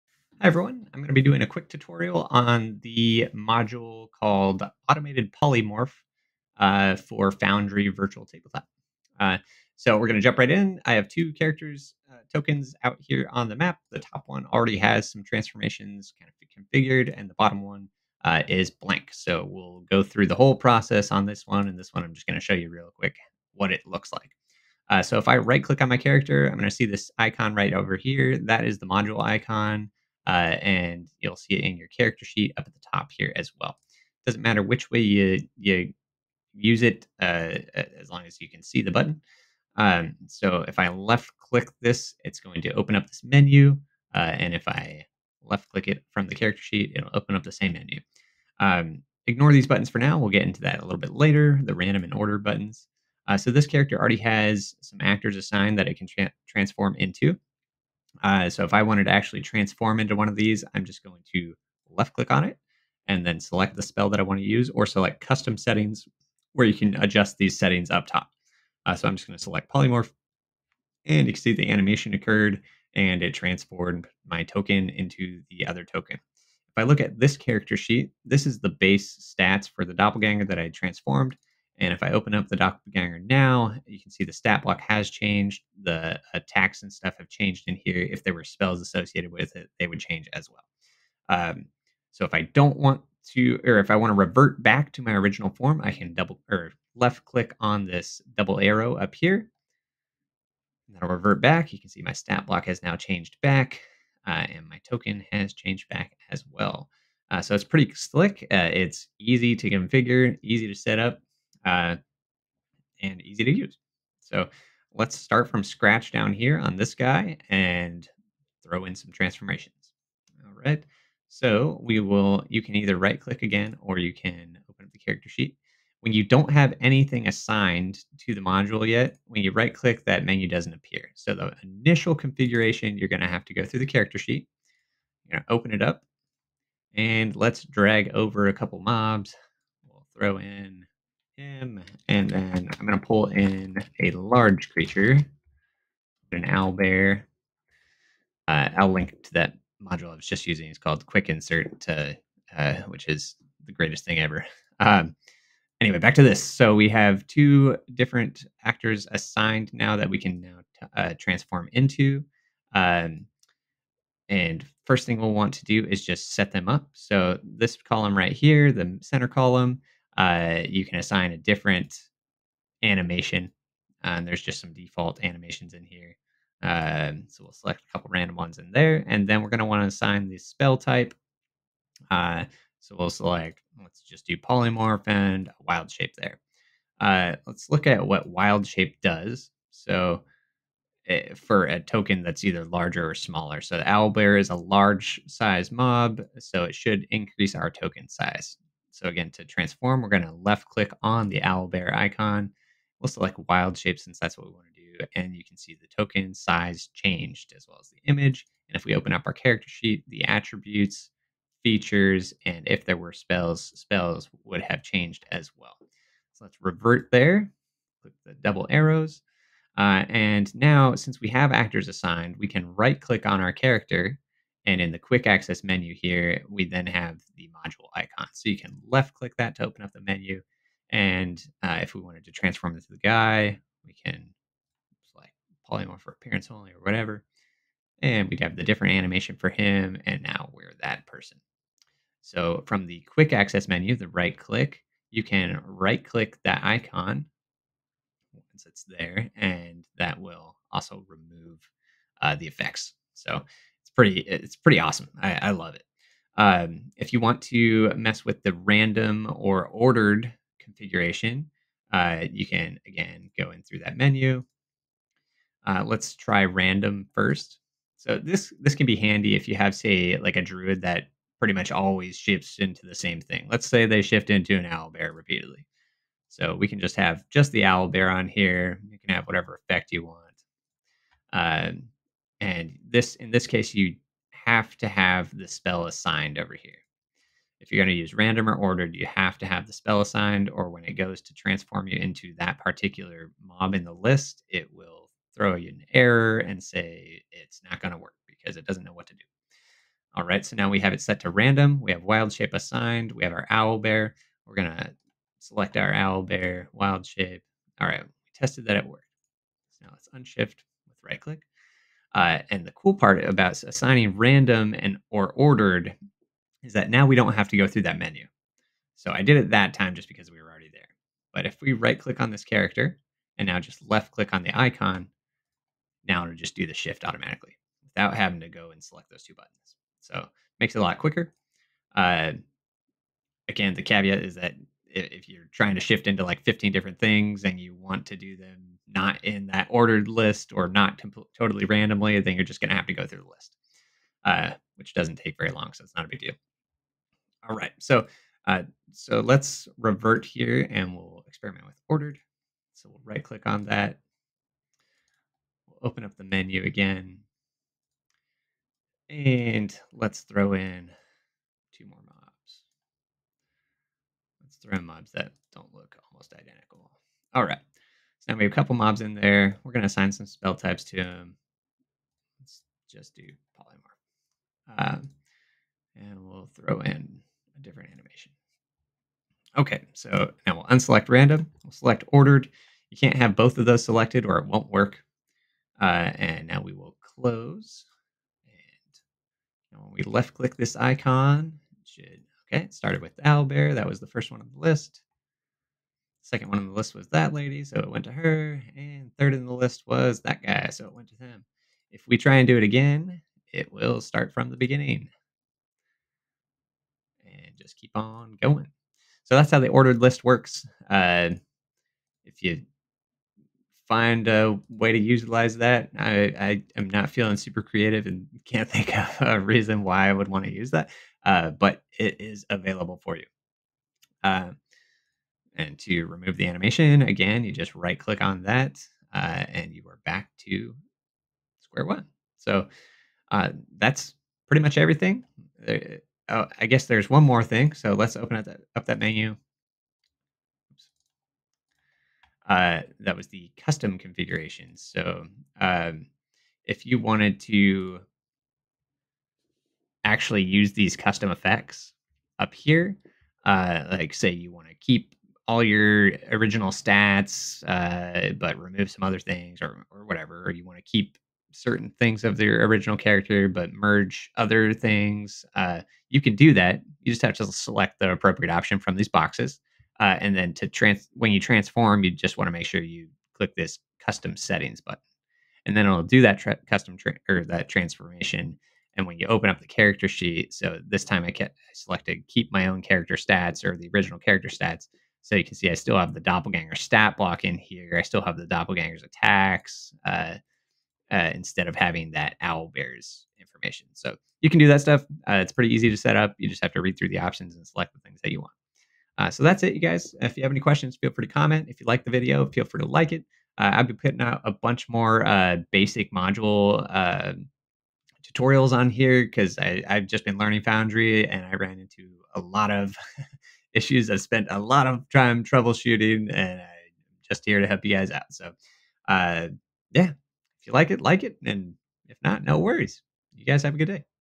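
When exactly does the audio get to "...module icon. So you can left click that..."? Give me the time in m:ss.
3:47.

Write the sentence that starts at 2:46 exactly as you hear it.
So this column right here, the center column, uh, you can assign a different animation.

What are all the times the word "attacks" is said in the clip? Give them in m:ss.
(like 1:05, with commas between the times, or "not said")
1:26, 8:09.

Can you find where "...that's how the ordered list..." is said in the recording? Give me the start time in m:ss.
6:49.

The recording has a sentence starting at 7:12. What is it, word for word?
So uh, that's pretty much everything.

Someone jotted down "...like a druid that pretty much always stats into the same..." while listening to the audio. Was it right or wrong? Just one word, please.
wrong.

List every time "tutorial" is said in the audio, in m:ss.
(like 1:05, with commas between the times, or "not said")
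0:01, 8:28.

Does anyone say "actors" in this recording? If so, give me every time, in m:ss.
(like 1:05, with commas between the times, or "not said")
0:55, 2:38, 3:41.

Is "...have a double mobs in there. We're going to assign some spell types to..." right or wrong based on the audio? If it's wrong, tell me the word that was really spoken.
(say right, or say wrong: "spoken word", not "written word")
wrong: "couple", not "double".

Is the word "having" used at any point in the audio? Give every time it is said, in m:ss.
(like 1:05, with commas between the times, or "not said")
5:28, 8:11.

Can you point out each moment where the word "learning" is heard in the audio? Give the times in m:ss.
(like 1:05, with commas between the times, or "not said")
8:30.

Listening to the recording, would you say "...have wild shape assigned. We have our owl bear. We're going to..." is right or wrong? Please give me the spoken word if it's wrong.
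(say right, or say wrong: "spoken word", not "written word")
right.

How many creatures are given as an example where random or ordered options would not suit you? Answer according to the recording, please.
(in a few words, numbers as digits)
15.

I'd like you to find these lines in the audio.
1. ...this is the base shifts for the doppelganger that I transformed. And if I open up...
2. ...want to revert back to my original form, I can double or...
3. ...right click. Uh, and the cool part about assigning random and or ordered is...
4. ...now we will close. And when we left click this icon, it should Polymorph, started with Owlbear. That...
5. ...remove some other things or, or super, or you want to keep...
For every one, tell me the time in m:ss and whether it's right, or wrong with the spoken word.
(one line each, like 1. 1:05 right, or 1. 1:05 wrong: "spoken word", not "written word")
1. 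1:18 wrong: "stats", not "shifts"
2. 1:33 right
3. 5:11 right
4. 6:26 wrong: "Okay", not "Polymorph"
5. 7:38 wrong: "whatever", not "super".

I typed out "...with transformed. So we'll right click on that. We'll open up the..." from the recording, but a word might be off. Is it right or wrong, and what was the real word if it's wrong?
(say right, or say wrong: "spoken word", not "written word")
wrong: "ordered", not "transformed".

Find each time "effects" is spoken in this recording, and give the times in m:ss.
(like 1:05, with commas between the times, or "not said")
4:12, 4:39, 7:31.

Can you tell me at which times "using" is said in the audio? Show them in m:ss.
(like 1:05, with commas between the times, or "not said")
2:30.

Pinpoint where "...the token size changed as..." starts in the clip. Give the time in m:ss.
3:25.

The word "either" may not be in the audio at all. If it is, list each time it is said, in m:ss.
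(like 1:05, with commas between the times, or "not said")
2:02, 3:12.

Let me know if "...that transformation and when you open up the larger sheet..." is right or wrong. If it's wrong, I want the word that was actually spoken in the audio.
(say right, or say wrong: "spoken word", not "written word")
wrong: "character", not "larger".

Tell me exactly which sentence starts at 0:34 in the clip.
Doesn't matter which way you, you use it uh, as long as you can see the button.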